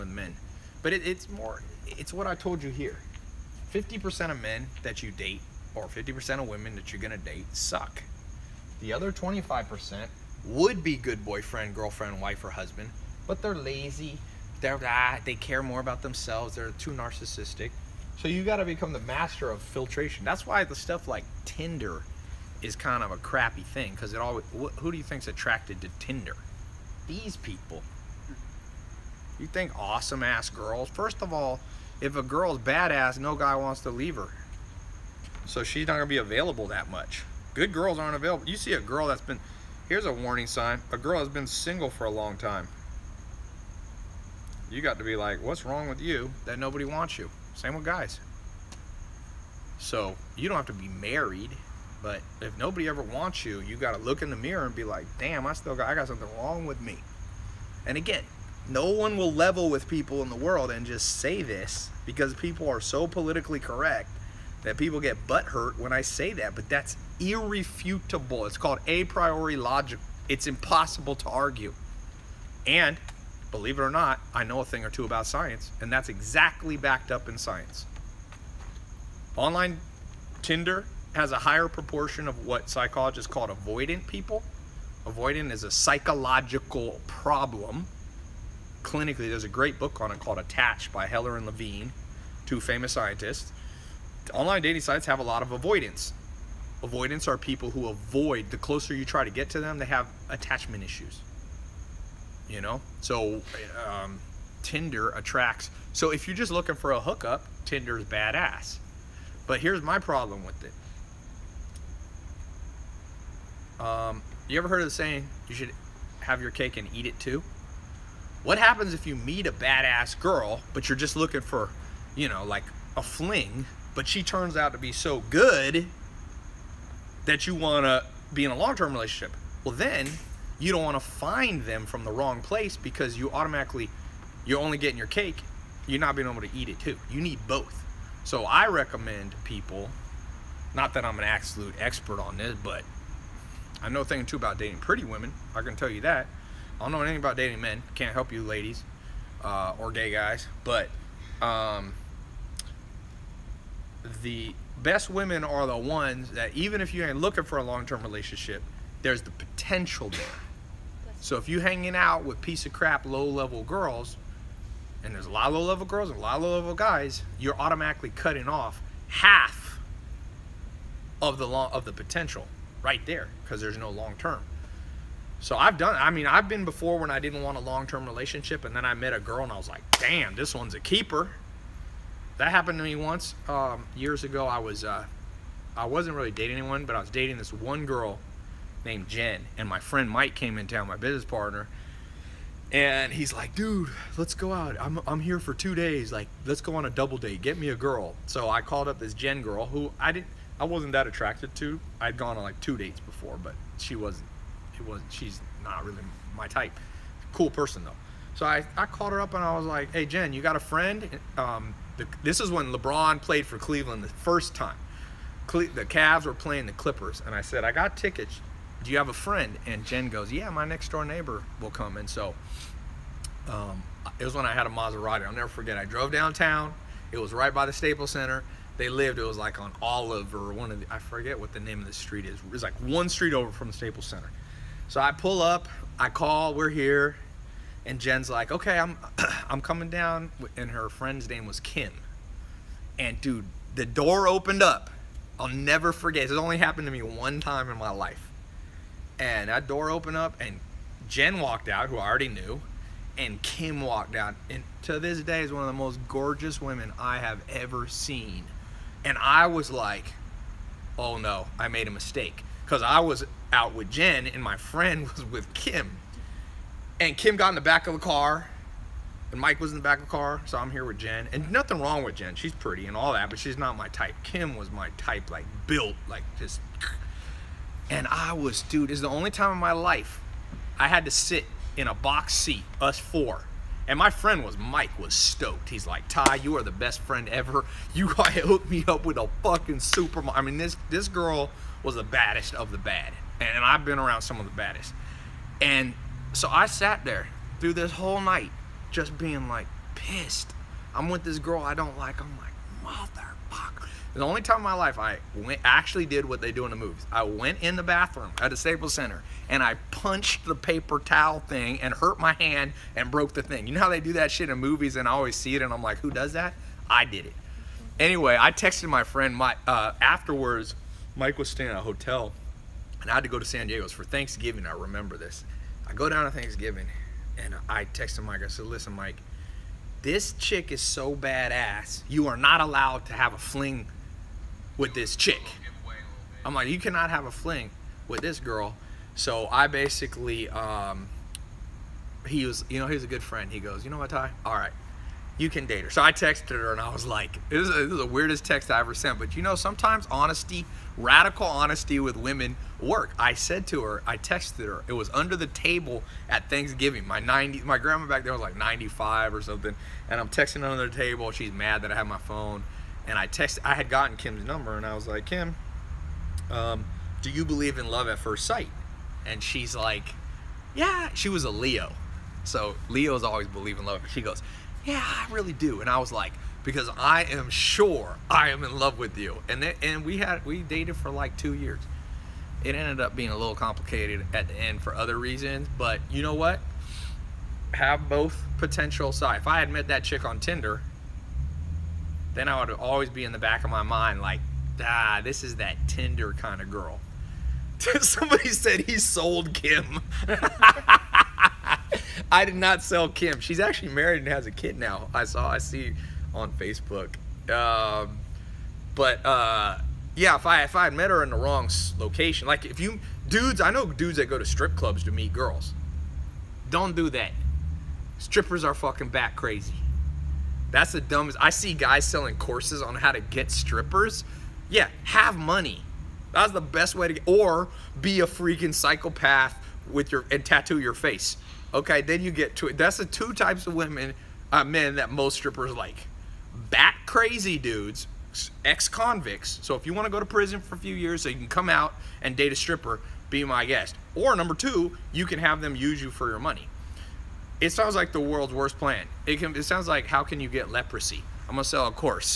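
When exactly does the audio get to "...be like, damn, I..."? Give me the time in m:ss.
0:54.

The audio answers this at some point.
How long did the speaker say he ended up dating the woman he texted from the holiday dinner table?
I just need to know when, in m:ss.
6:21.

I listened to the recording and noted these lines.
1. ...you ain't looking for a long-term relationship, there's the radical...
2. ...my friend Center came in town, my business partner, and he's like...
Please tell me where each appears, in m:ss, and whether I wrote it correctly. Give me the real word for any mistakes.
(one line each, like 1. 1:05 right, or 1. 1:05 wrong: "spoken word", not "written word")
1. 2:36 wrong: "potential", not "radical"
2. 3:09 wrong: "Mike", not "Center".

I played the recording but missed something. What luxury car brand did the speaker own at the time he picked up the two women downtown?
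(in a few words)
Maserati.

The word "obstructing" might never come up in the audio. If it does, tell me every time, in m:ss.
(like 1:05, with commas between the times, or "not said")
not said.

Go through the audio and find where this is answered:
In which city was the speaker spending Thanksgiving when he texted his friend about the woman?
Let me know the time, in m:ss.
5:23.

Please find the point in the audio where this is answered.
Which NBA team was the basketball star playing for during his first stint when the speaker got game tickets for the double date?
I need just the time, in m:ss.
3:33.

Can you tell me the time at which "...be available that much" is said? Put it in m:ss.
0:36.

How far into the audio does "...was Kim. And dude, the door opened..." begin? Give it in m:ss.
4:01.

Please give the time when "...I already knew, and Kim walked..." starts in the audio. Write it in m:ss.
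4:11.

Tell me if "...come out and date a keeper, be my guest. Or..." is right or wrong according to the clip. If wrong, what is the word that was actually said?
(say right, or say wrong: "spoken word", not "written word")
wrong: "stripper", not "keeper".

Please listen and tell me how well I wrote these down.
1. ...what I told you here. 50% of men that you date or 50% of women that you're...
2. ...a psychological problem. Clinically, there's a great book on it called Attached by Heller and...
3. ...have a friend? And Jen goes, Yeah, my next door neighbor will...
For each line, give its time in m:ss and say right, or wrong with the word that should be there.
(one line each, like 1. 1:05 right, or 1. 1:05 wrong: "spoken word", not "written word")
1. 0:02 right
2. 1:25 right
3. 3:38 right.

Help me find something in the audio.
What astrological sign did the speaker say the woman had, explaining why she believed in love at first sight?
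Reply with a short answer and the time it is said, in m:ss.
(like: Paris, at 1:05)
Leo, at 6:11.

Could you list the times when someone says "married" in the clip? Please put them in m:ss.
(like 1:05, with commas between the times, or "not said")
0:50, 6:43.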